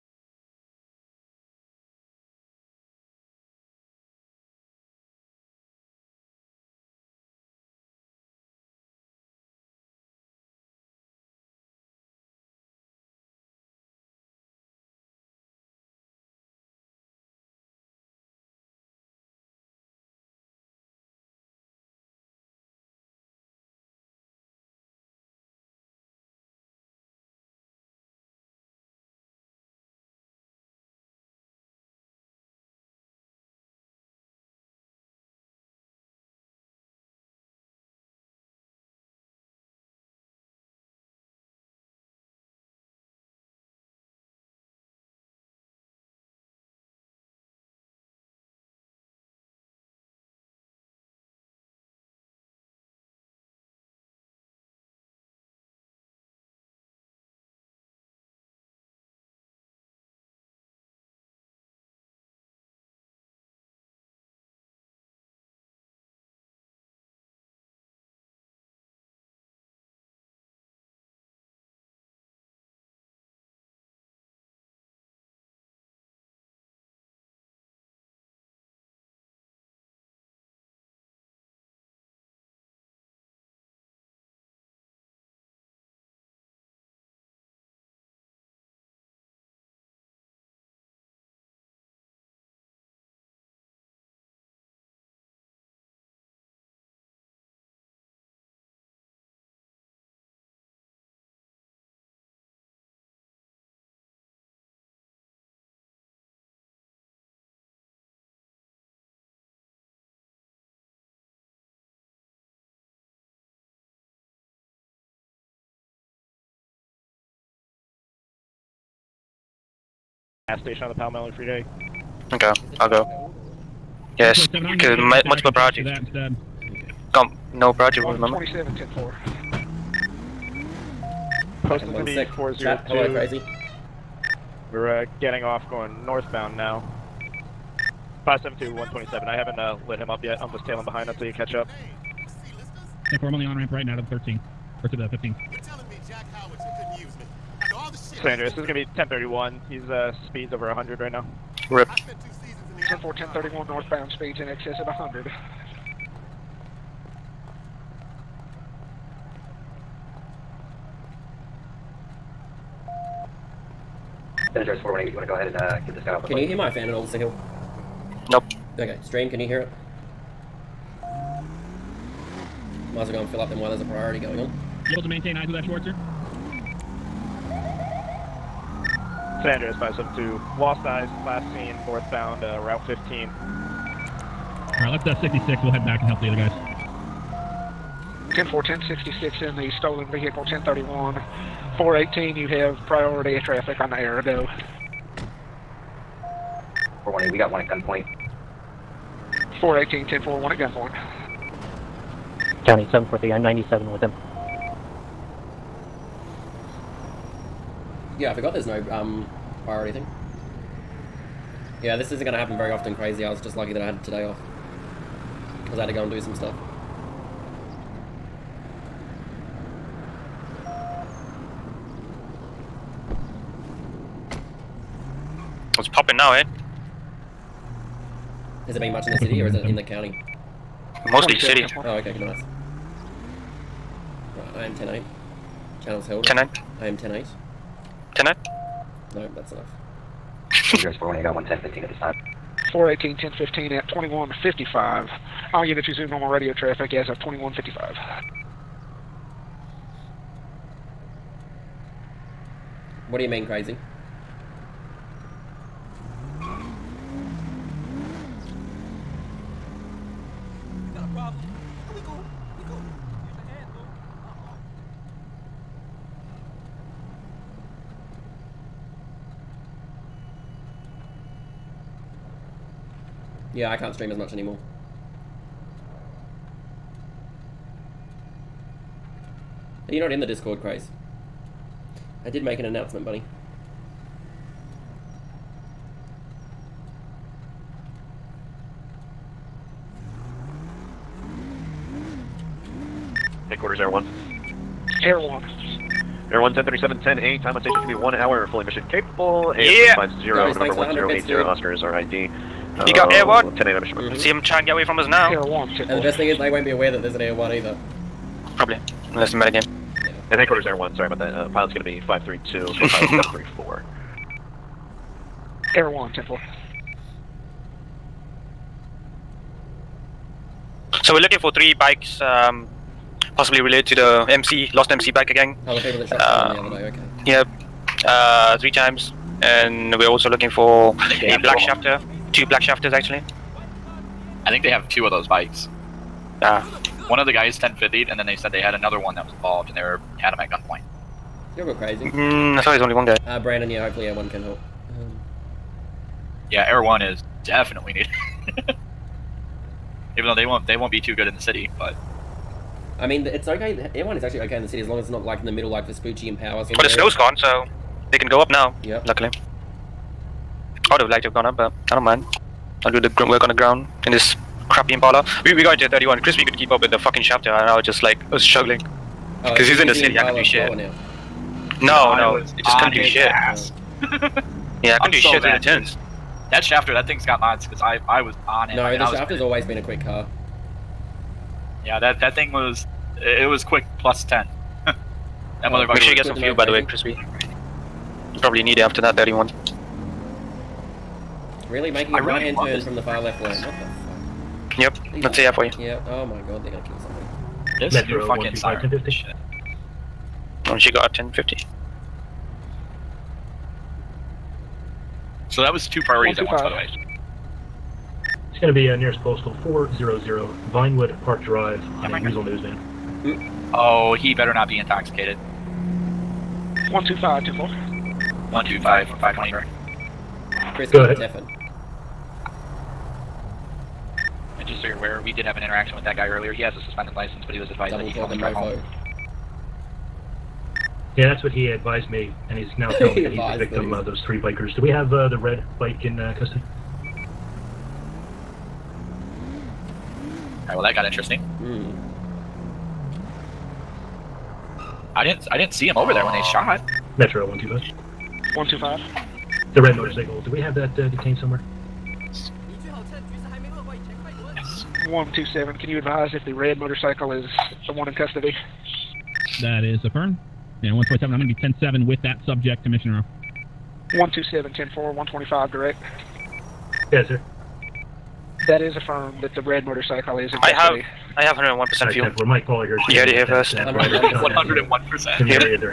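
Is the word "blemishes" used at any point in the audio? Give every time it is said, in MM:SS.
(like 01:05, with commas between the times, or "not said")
not said.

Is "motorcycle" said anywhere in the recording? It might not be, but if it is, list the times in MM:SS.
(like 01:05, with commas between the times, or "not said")
07:29, 07:36, 07:49.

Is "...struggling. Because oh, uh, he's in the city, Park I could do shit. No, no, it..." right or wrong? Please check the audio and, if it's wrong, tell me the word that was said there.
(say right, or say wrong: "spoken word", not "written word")
wrong: "Impala", not "Park".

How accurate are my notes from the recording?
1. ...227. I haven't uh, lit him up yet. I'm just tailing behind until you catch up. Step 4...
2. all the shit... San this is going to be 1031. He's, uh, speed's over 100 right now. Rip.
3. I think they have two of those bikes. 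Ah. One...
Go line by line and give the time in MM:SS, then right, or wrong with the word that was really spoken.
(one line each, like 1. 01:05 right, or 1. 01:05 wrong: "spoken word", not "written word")
1. 02:18 wrong: "127", not "227"
2. 02:27 right
3. 05:34 right.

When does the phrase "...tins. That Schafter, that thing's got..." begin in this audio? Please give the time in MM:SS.
06:15.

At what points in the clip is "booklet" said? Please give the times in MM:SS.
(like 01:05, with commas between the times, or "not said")
not said.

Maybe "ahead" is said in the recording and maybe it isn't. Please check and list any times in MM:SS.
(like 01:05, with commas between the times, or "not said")
02:45, 07:01.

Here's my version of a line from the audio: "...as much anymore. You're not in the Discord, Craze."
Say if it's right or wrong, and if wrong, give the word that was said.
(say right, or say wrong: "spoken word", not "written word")
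right.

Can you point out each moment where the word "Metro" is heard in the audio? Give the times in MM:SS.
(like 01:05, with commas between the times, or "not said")
06:37, 07:27.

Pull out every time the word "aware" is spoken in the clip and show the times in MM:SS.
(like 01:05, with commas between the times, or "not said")
05:06, 07:04.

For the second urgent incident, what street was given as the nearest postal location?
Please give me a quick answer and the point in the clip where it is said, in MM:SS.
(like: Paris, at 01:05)
Vinewood Park Drive, at 06:50.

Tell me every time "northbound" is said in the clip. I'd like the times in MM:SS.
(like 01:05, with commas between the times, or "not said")
02:16, 02:33, 03:01.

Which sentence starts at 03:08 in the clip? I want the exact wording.
10 4, 1066 in the stolen vehicle, 1031.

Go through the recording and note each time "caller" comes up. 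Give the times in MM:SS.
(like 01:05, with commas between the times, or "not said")
07:52.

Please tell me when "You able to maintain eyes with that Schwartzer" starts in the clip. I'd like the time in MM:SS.
02:54.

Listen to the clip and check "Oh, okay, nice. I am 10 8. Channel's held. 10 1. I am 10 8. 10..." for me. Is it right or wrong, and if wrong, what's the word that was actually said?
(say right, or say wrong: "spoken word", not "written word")
wrong: "8", not "1".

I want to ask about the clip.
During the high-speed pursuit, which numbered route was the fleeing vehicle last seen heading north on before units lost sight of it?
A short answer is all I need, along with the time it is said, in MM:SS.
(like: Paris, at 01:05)
Route 15, at 03:02.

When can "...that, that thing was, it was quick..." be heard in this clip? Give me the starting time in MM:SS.
06:21.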